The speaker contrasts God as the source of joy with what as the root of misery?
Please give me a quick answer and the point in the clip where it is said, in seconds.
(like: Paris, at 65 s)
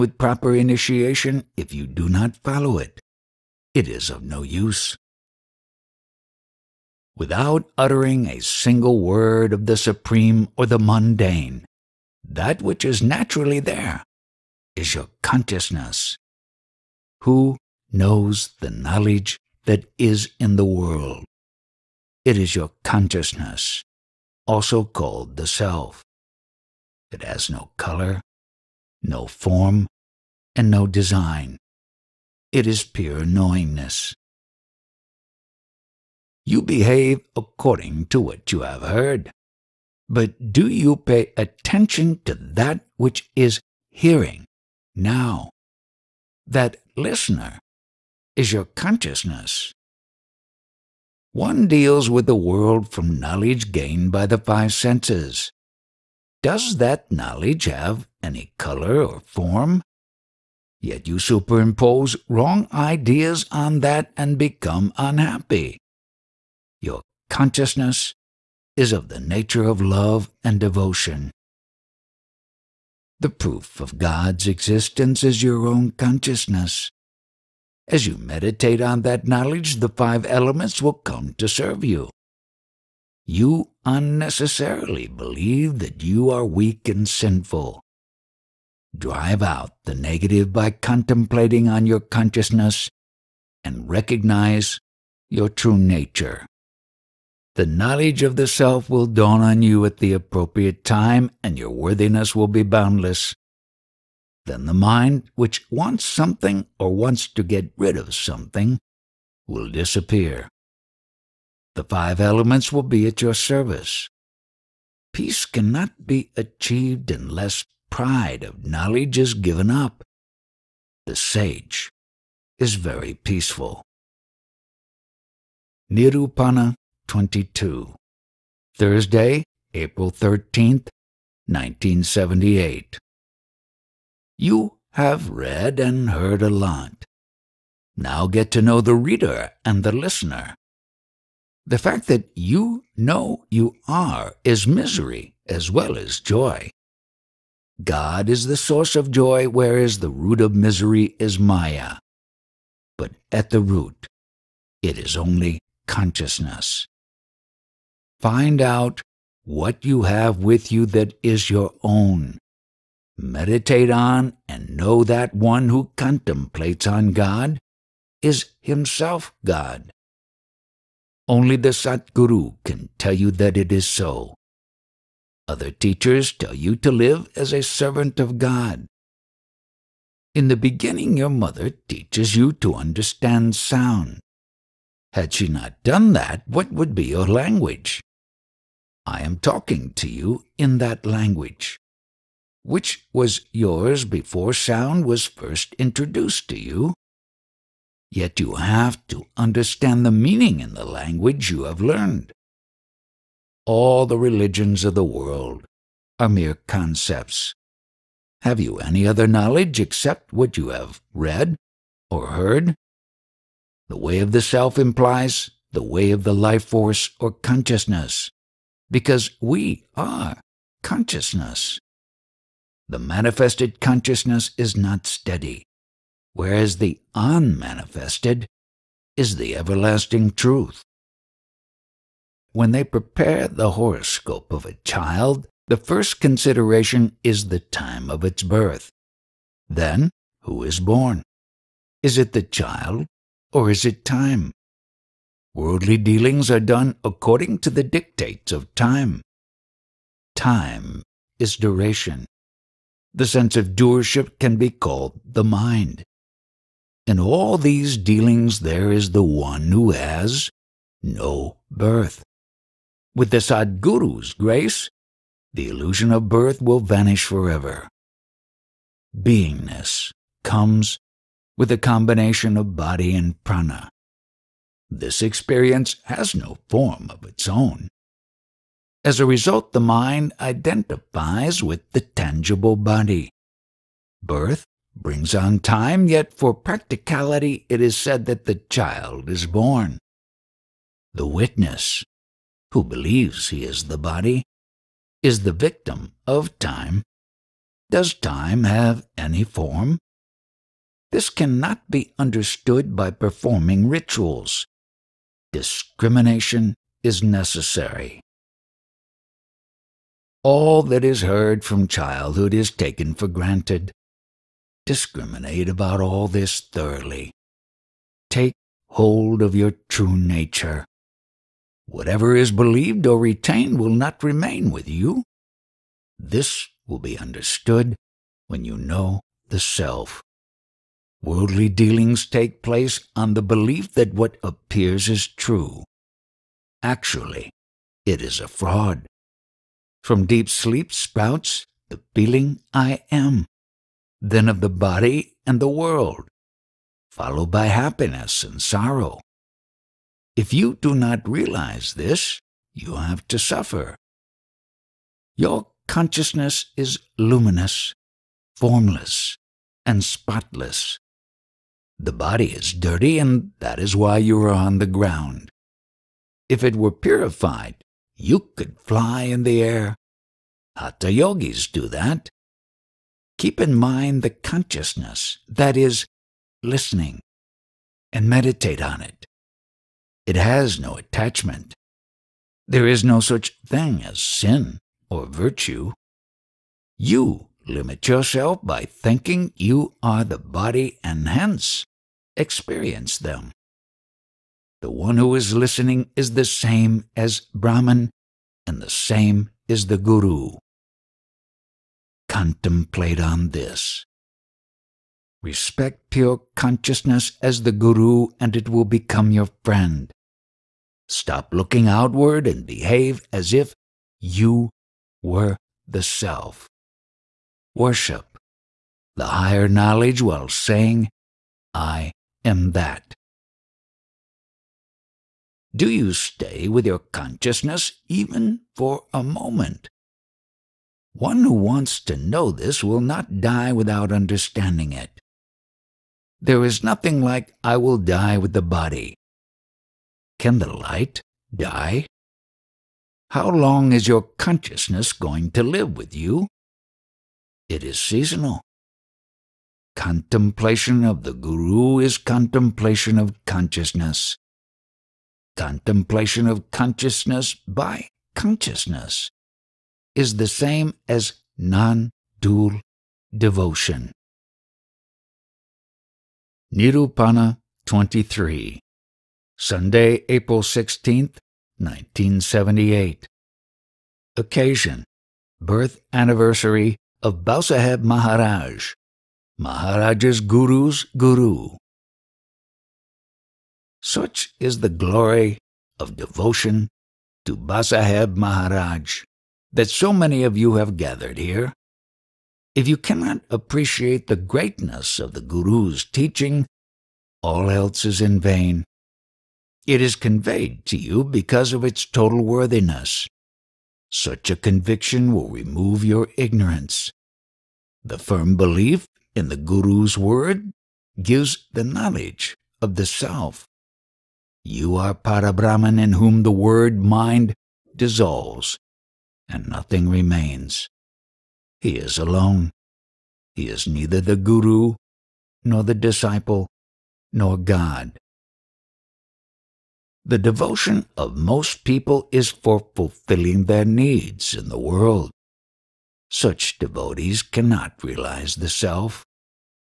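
Maya, at 151 s.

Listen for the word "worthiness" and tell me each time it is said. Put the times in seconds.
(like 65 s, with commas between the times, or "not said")
101 s, 502 s.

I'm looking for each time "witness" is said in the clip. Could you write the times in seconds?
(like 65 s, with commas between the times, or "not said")
291 s.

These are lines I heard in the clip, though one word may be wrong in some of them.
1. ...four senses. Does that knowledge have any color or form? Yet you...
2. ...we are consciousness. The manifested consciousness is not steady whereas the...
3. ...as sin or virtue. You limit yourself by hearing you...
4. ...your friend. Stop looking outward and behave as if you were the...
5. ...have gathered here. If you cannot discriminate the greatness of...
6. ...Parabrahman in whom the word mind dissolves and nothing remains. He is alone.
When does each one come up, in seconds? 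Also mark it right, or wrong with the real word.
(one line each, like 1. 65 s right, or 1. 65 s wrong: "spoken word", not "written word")
1. 54 s wrong: "five", not "four"
2. 219 s right
3. 384 s wrong: "thinking", not "hearing"
4. 409 s right
5. 490 s wrong: "appreciate", not "discriminate"
6. 515 s right.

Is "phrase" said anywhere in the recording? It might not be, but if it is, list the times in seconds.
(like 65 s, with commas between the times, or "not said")
not said.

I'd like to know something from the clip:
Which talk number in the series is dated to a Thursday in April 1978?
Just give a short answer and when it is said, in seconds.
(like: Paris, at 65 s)
22, at 125 s.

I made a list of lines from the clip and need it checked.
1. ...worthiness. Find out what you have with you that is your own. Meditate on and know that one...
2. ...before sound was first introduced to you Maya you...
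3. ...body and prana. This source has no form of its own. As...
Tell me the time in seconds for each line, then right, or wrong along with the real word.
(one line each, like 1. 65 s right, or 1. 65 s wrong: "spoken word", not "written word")
1. 155 s wrong: "consciousness", not "worthiness"
2. 194 s wrong: "Yet", not "Maya"
3. 272 s wrong: "experience", not "source".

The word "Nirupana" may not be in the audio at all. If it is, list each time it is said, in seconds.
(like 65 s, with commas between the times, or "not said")
125 s, 466 s.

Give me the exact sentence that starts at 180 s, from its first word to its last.
In the beginning, your mother teaches you to understand sound.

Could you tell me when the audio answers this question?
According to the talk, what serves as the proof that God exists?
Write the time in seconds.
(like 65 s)
75 s.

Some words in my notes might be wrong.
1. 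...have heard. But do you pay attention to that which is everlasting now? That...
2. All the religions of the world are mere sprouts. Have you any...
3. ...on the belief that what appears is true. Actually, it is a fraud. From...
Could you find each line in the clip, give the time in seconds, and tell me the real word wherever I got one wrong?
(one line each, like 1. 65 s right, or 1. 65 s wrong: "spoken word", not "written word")
1. 38 s wrong: "hearing", not "everlasting"
2. 203 s wrong: "concepts", not "sprouts"
3. 333 s right.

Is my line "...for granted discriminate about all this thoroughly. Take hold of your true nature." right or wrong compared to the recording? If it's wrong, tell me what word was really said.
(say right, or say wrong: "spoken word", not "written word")
right.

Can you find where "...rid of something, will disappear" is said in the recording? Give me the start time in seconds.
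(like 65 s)
107 s.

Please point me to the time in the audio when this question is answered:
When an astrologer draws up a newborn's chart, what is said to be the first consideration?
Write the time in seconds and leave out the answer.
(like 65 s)
237 s.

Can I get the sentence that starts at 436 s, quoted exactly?
There is nothing like I will die with the body.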